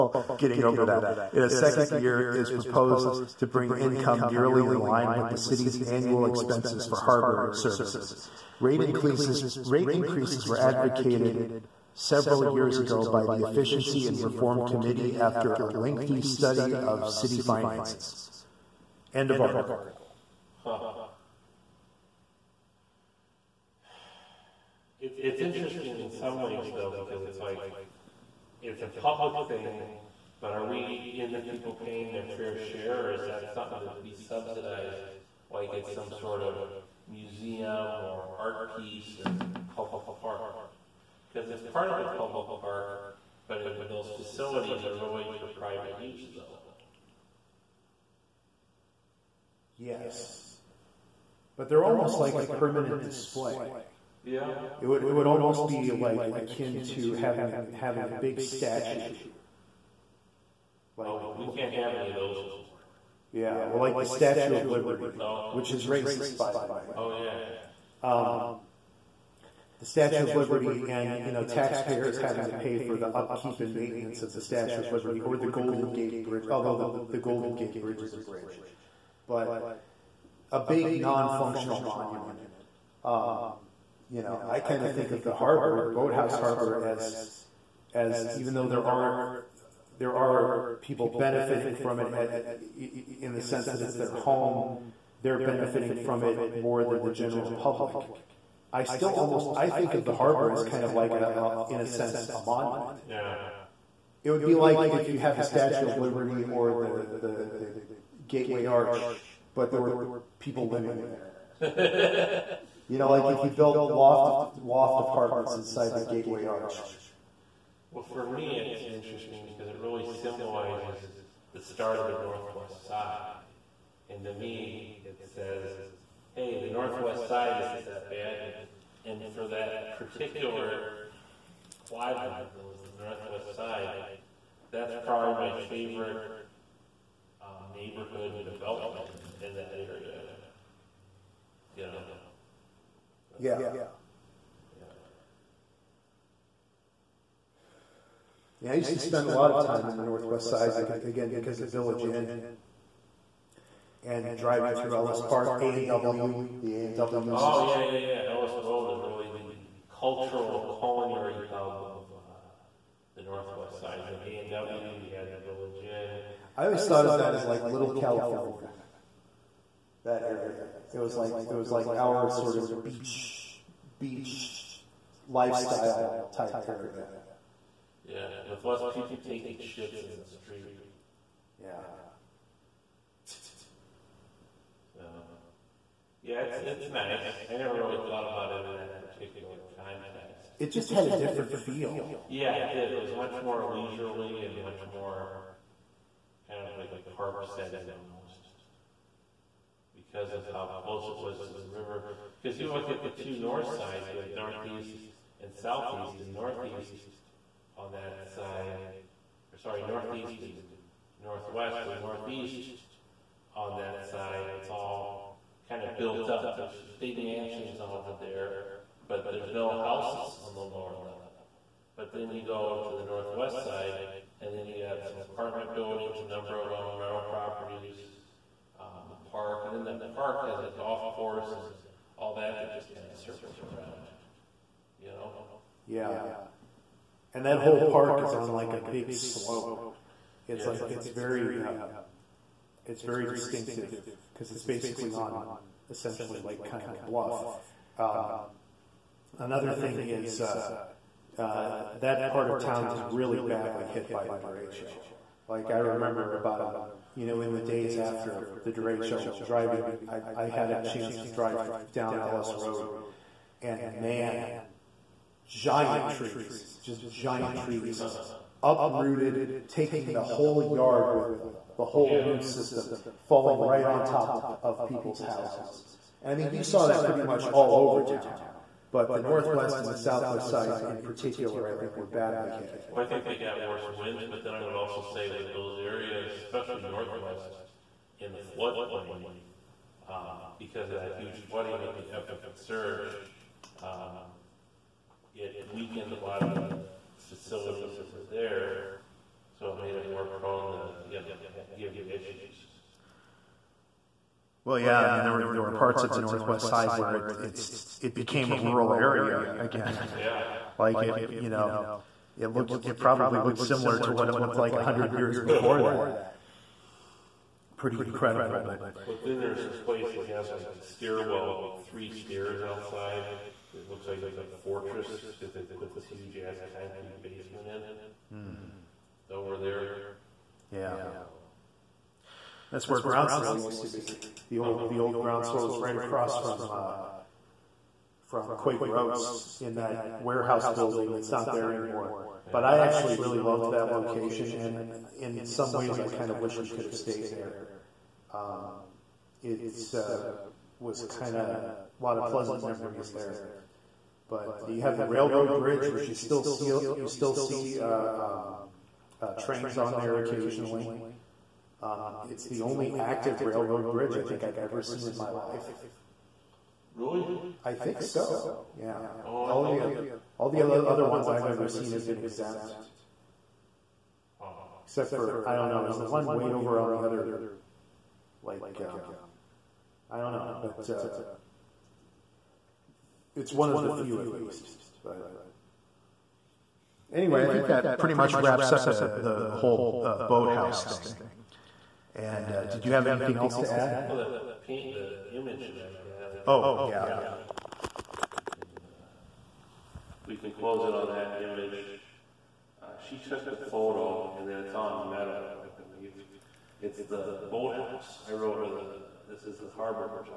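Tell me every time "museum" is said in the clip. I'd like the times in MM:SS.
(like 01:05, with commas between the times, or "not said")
00:37.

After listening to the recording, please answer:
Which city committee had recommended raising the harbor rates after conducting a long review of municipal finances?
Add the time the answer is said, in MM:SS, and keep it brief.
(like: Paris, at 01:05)
Efficiency and Reform Committee, at 00:13.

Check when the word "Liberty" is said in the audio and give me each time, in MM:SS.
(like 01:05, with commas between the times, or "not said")
01:04, 01:10, 01:14, 01:45.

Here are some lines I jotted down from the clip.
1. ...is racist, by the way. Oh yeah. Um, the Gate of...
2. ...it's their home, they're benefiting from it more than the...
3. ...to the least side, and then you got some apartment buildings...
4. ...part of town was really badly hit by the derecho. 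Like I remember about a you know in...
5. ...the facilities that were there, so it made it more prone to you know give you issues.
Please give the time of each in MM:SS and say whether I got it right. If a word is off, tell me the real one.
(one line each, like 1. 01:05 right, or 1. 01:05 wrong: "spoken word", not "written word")
1. 01:05 wrong: "Statue", not "Gate"
2. 01:33 right
3. 03:42 wrong: "northwest", not "least"
4. 04:12 right
5. 04:56 right.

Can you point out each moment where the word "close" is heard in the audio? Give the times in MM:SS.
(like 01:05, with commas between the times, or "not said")
03:20, 06:40.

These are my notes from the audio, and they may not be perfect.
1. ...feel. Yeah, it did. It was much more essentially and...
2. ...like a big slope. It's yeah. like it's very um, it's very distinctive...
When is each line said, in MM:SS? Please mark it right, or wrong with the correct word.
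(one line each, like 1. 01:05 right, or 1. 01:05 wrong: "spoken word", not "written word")
1. 03:11 wrong: "leisurely", not "essentially"
2. 03:58 right.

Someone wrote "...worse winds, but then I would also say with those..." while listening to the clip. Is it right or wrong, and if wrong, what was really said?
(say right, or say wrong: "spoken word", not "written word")
right.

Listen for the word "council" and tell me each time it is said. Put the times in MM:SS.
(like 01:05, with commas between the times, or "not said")
not said.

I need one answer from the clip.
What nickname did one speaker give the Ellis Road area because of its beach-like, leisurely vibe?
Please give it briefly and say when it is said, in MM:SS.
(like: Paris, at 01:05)
Little California, at 02:47.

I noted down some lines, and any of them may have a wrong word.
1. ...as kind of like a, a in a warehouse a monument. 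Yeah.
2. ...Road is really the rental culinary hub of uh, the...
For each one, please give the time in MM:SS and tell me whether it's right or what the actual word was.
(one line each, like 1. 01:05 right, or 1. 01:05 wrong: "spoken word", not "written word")
1. 01:40 wrong: "sense", not "warehouse"
2. 02:38 wrong: "cultural", not "rental".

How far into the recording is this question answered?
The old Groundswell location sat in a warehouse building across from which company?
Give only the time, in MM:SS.
05:38.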